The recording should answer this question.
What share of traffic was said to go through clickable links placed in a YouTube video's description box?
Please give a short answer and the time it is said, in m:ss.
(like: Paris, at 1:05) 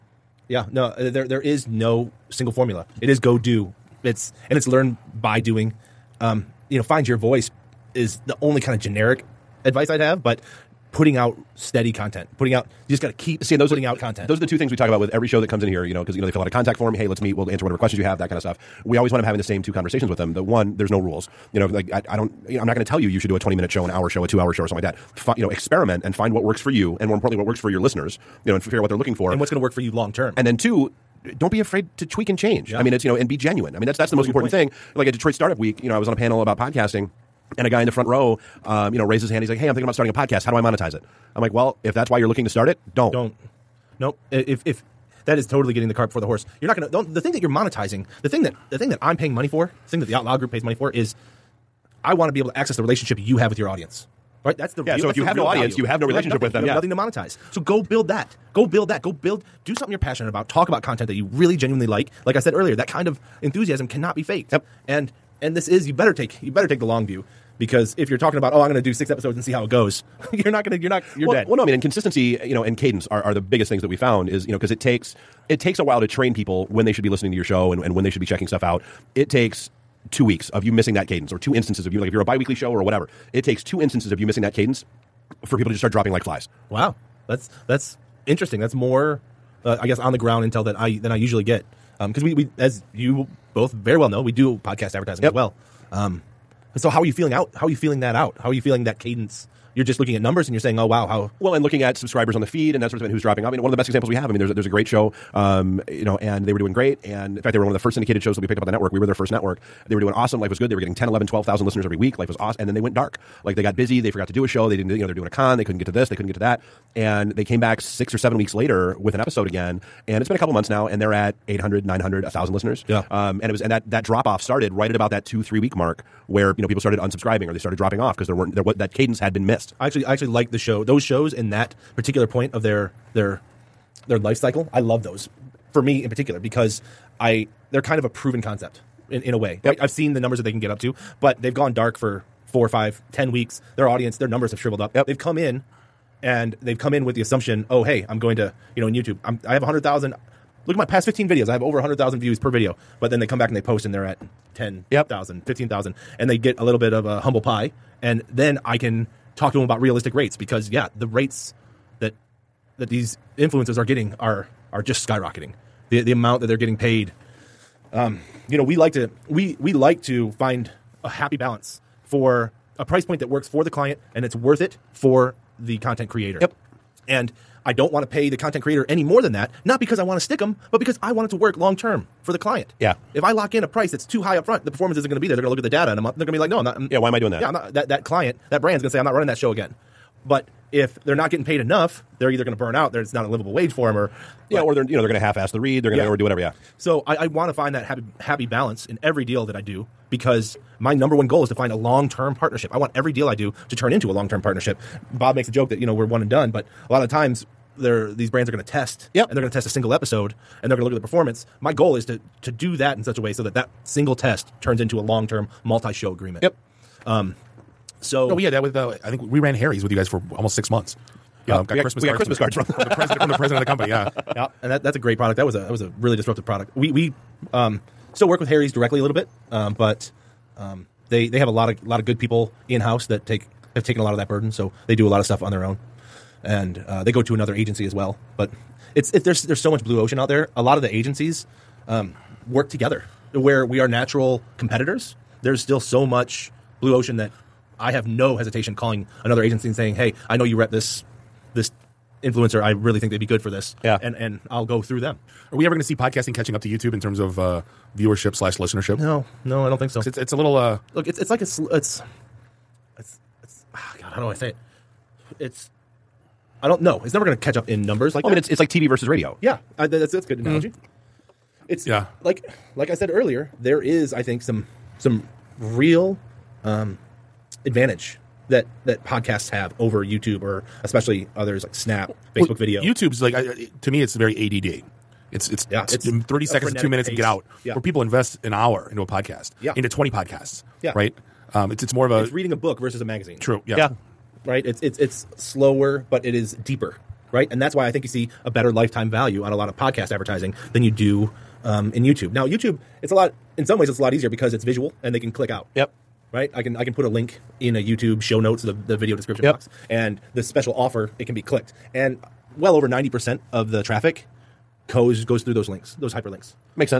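over 90 percent, at 5:12.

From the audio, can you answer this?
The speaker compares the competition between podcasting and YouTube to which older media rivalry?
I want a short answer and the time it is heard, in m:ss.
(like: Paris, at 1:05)
TV versus radio, at 4:28.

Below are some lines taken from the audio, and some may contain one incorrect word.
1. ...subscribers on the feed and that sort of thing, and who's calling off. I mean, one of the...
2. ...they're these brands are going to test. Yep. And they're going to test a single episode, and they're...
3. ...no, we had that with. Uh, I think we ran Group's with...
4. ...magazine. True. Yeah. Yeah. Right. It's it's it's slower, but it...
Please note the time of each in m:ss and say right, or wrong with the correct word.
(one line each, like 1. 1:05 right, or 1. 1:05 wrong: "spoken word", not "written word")
1. 1:41 wrong: "dropping", not "calling"
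2. 3:27 right
3. 3:38 wrong: "Harry", not "Group"
4. 4:53 right.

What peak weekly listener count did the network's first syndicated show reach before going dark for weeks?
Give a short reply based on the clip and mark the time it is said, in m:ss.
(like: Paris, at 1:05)
12,000, at 1:51.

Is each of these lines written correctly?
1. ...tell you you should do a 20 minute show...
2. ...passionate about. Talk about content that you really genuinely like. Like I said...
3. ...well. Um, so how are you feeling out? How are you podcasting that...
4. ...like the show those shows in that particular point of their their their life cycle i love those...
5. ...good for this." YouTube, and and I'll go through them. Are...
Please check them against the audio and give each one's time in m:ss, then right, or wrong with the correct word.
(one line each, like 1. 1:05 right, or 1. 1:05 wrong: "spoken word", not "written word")
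1. 0:22 right
2. 0:59 right
3. 1:35 wrong: "feeling", not "podcasting"
4. 2:10 right
5. 4:13 wrong: "Yeah", not "YouTube".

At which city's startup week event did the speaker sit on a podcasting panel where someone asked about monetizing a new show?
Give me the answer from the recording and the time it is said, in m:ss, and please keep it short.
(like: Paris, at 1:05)
Detroit, at 0:35.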